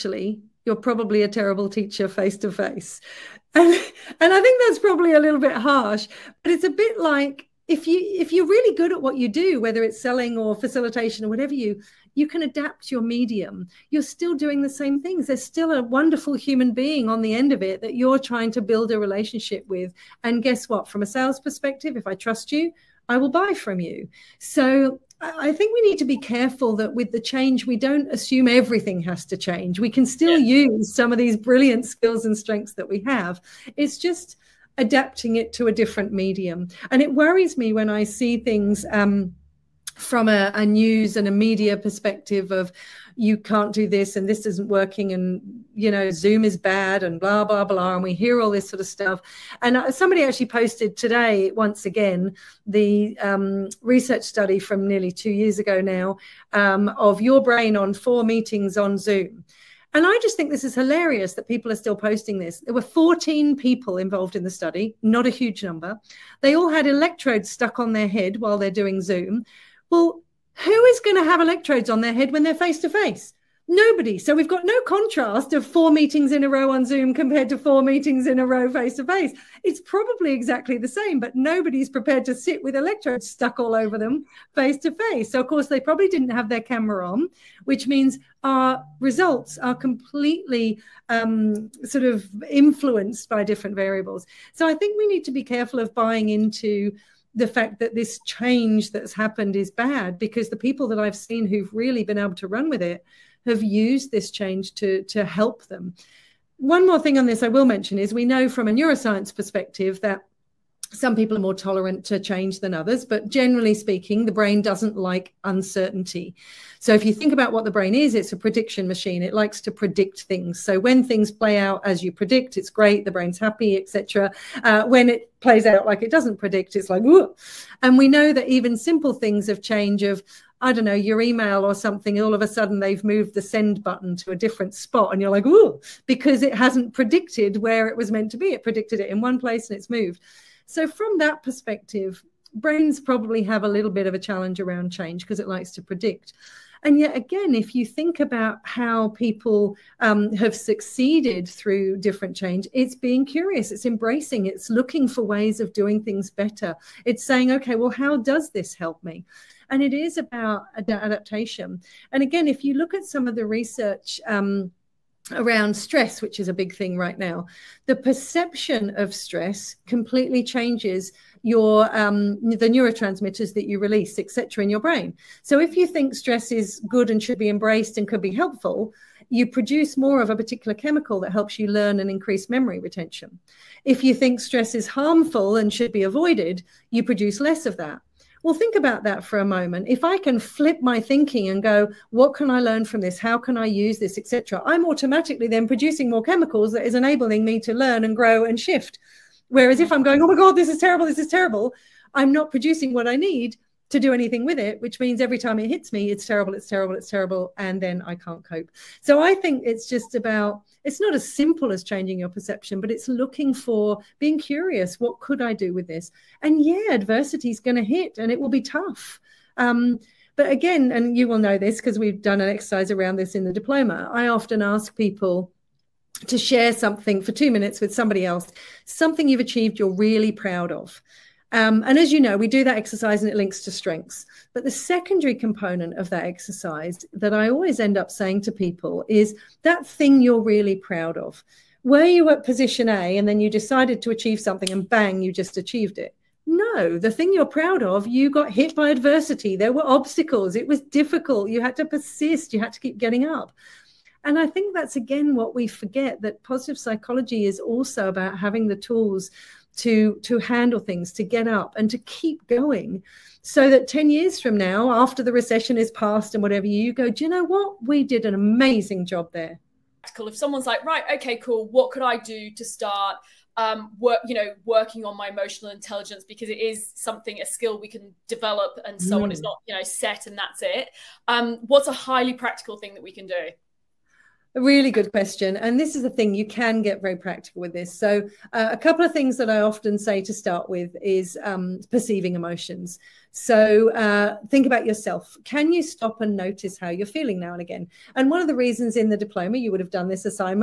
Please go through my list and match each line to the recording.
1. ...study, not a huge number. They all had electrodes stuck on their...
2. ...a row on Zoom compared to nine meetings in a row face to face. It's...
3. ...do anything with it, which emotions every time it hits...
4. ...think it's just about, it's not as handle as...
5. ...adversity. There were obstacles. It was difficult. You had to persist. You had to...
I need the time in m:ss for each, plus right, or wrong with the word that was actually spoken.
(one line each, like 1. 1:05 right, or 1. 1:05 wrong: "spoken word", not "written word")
1. 1:04 right
2. 1:16 wrong: "four", not "nine"
3. 3:23 wrong: "means", not "emotions"
4. 3:29 wrong: "simple", not "handle"
5. 4:08 right.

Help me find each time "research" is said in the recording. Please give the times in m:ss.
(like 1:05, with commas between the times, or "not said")
0:53, 2:43.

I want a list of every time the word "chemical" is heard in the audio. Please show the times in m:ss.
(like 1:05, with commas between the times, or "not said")
3:00, 3:16.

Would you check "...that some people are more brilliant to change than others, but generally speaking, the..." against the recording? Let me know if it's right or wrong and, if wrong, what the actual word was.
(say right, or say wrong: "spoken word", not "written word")
wrong: "tolerant", not "brilliant".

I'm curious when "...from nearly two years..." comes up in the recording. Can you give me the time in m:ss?
0:54.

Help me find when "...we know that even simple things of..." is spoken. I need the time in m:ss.
2:07.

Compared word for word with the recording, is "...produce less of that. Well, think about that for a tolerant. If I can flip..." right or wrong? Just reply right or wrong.
wrong.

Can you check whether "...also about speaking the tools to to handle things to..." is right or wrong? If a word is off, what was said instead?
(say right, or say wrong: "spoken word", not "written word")
wrong: "having", not "speaking".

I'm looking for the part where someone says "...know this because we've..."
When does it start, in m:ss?
3:41.